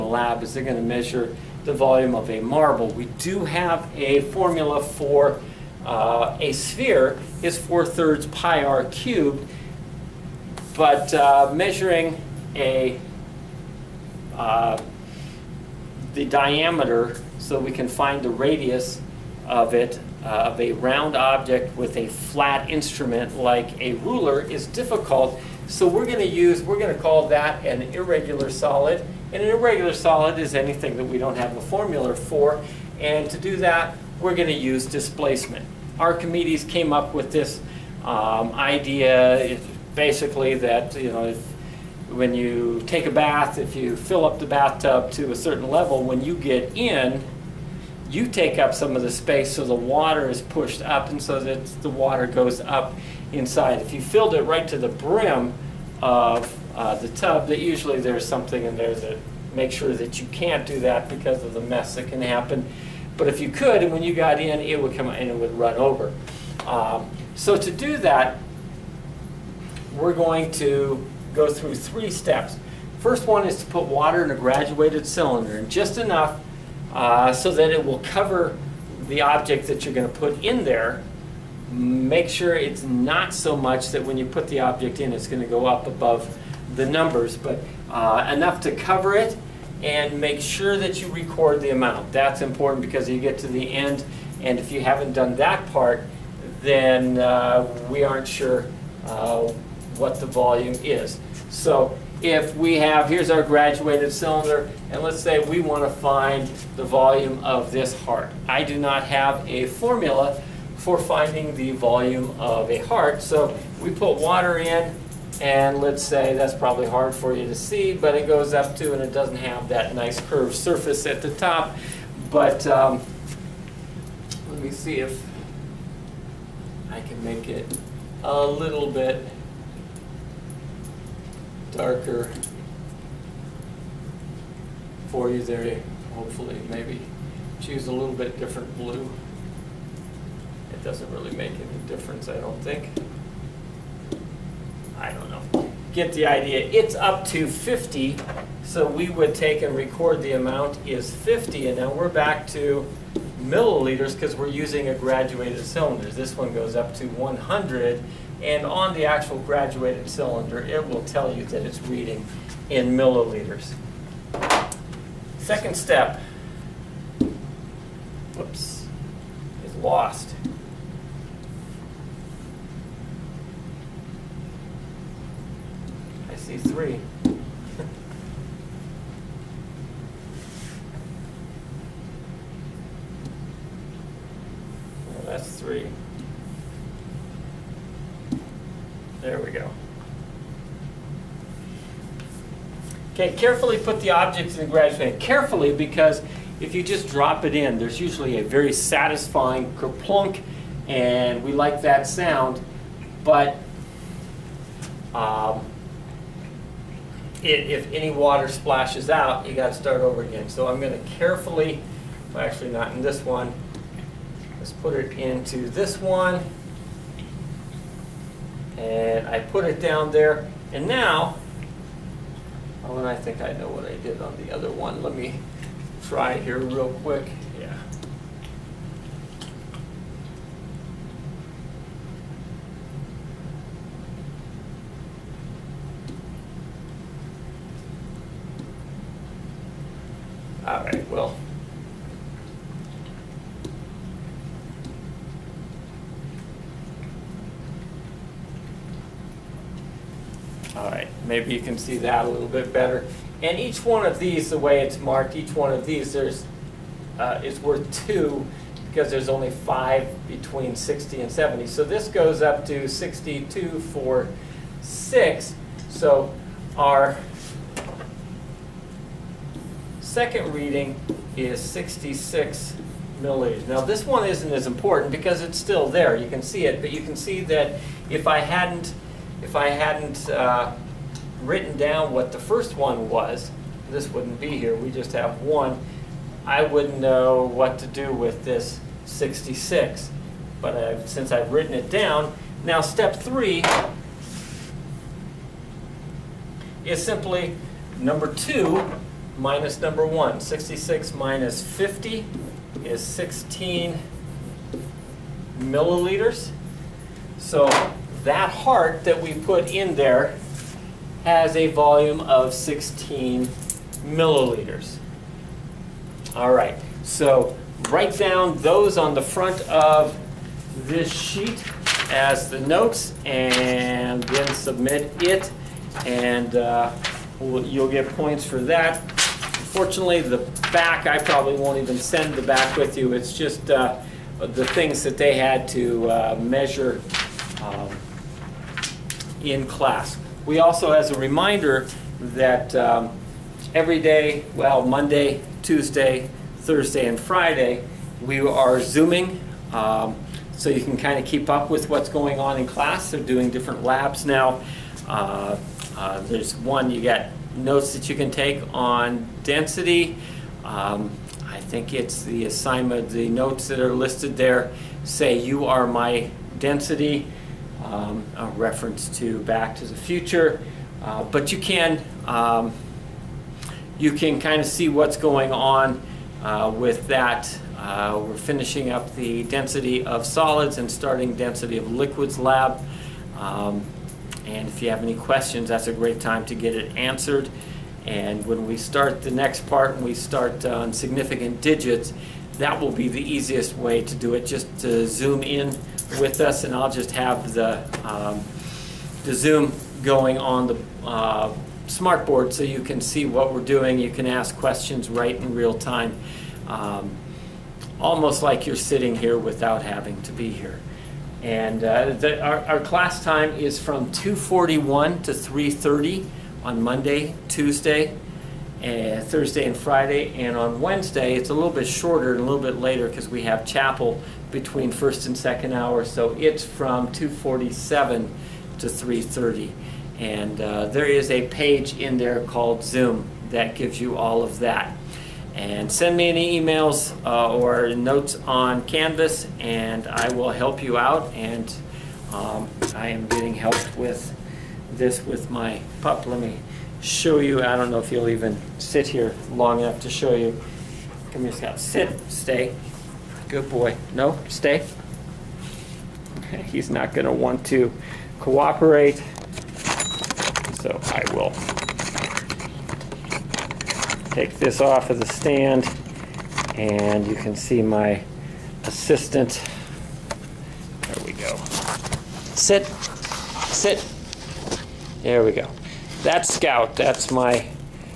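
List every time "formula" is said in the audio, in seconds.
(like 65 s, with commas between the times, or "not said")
4 s, 31 s, 109 s.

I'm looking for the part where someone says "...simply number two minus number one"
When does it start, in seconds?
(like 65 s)
297 s.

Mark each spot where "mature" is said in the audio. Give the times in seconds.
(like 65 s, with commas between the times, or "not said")
not said.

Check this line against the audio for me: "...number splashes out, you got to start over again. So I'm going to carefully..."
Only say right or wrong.
wrong.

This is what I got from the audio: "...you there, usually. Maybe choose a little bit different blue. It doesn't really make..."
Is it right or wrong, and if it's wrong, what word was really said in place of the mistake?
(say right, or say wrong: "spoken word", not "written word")
wrong: "hopefully", not "usually".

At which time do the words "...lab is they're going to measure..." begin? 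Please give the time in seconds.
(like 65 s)
0 s.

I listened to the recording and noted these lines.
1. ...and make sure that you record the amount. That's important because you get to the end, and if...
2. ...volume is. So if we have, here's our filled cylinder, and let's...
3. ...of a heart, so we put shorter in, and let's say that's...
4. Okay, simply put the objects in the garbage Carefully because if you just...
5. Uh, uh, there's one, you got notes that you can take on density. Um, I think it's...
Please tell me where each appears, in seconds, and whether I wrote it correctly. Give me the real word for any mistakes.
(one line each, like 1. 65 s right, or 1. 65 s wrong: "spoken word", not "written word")
1. 89 s right
2. 100 s wrong: "graduated", not "filled"
3. 112 s wrong: "water", not "shorter"
4. 193 s wrong: "carefully", not "simply"
5. 355 s right.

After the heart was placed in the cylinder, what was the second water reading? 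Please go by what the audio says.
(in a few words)
66 milliliters.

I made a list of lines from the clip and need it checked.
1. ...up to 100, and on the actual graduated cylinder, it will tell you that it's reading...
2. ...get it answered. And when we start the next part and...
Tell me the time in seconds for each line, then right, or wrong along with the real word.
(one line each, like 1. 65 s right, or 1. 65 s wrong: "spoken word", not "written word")
1. 156 s right
2. 386 s right.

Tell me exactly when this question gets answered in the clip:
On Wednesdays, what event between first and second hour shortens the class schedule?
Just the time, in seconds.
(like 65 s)
423 s.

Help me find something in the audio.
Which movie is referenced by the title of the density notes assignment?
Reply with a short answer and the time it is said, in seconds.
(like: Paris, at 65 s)
Back to the Future, at 369 s.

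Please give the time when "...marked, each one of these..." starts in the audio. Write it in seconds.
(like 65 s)
255 s.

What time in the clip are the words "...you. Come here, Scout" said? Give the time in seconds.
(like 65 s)
450 s.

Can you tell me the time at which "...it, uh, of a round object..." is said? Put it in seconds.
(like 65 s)
19 s.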